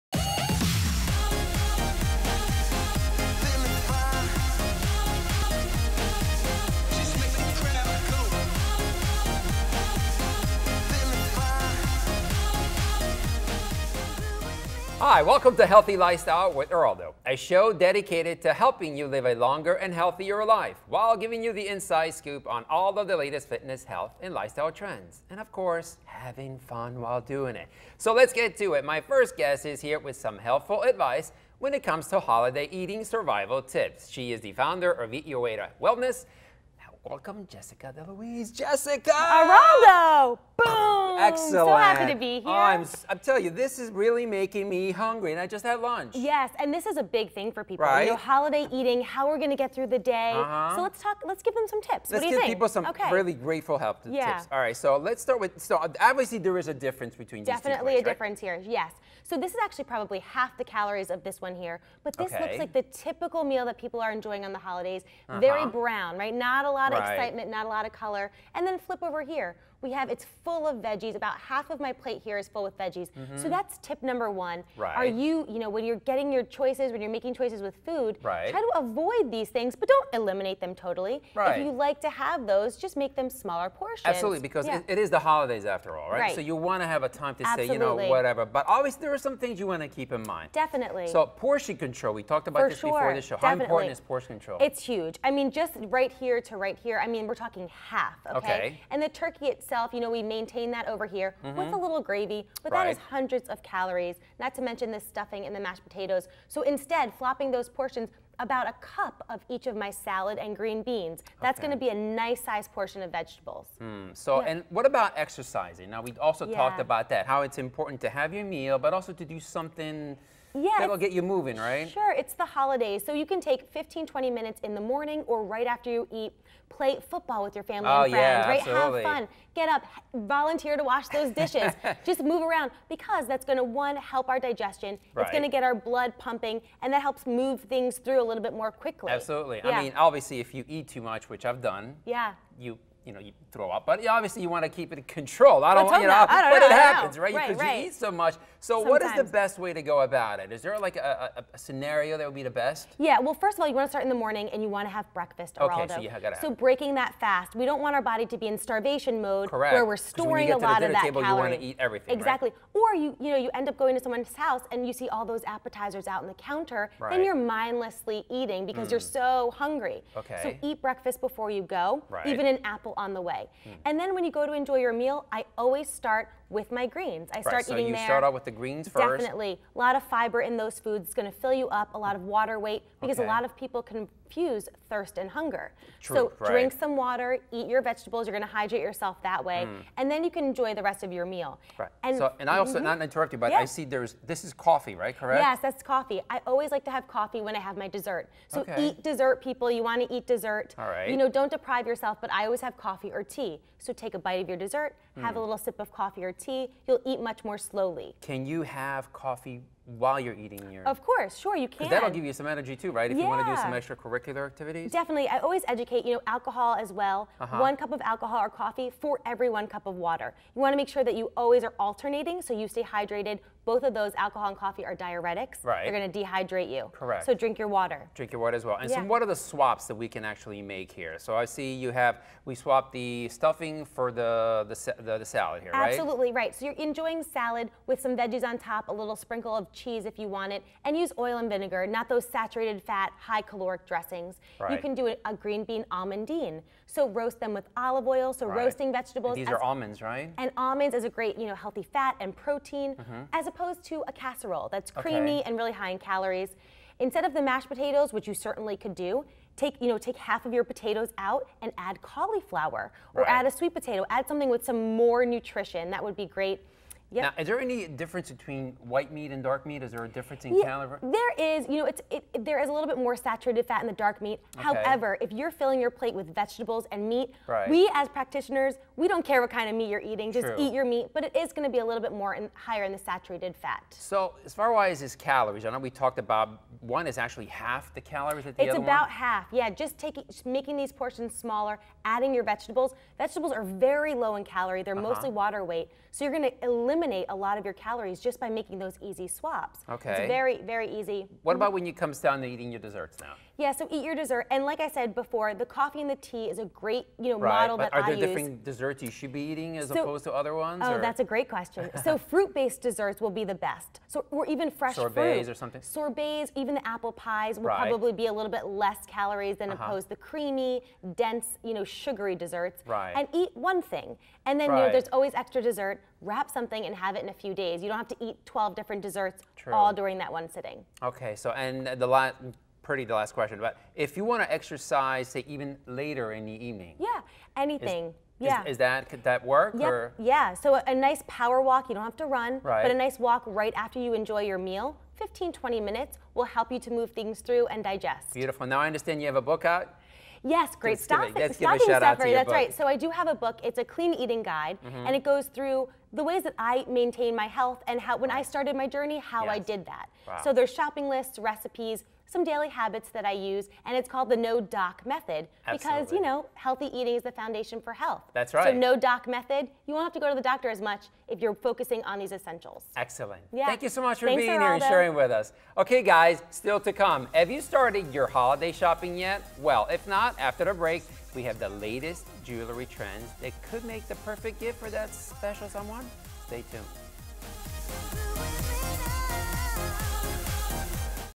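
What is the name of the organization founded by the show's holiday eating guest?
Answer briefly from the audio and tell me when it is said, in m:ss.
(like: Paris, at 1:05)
Eat Your Way to Wellness, at 0:35.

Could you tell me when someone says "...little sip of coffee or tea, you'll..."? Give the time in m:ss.
3:25.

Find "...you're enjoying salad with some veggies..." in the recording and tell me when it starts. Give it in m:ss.
3:56.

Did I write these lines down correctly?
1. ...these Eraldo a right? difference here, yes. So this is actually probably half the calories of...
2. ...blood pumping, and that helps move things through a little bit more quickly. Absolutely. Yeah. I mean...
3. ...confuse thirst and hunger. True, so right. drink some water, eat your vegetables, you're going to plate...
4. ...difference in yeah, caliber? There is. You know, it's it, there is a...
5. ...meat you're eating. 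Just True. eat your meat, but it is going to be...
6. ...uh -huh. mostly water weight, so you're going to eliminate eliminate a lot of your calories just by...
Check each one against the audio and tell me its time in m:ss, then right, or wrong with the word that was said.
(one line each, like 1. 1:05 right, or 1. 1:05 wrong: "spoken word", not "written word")
1. 0:57 wrong: "Definitely", not "Eraldo"
2. 2:15 right
3. 3:03 wrong: "hydrate", not "plate"
4. 4:30 right
5. 4:39 right
6. 4:54 right.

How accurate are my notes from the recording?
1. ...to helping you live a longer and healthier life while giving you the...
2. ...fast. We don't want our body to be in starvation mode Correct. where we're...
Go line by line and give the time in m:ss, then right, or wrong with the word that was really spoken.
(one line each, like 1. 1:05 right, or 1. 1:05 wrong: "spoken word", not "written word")
1. 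0:18 right
2. 2:37 right.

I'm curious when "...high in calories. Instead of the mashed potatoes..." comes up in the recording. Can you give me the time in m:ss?
4:15.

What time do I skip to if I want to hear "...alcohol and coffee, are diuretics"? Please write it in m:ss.
3:44.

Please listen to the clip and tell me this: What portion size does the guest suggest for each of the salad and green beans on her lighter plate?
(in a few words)
About a cup.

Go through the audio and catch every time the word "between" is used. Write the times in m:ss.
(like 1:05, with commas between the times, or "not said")
0:57, 4:28.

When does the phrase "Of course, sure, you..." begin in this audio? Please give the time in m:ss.
3:30.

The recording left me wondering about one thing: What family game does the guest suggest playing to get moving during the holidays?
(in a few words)
Football.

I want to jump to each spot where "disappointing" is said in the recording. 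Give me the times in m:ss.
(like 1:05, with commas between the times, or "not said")
not said.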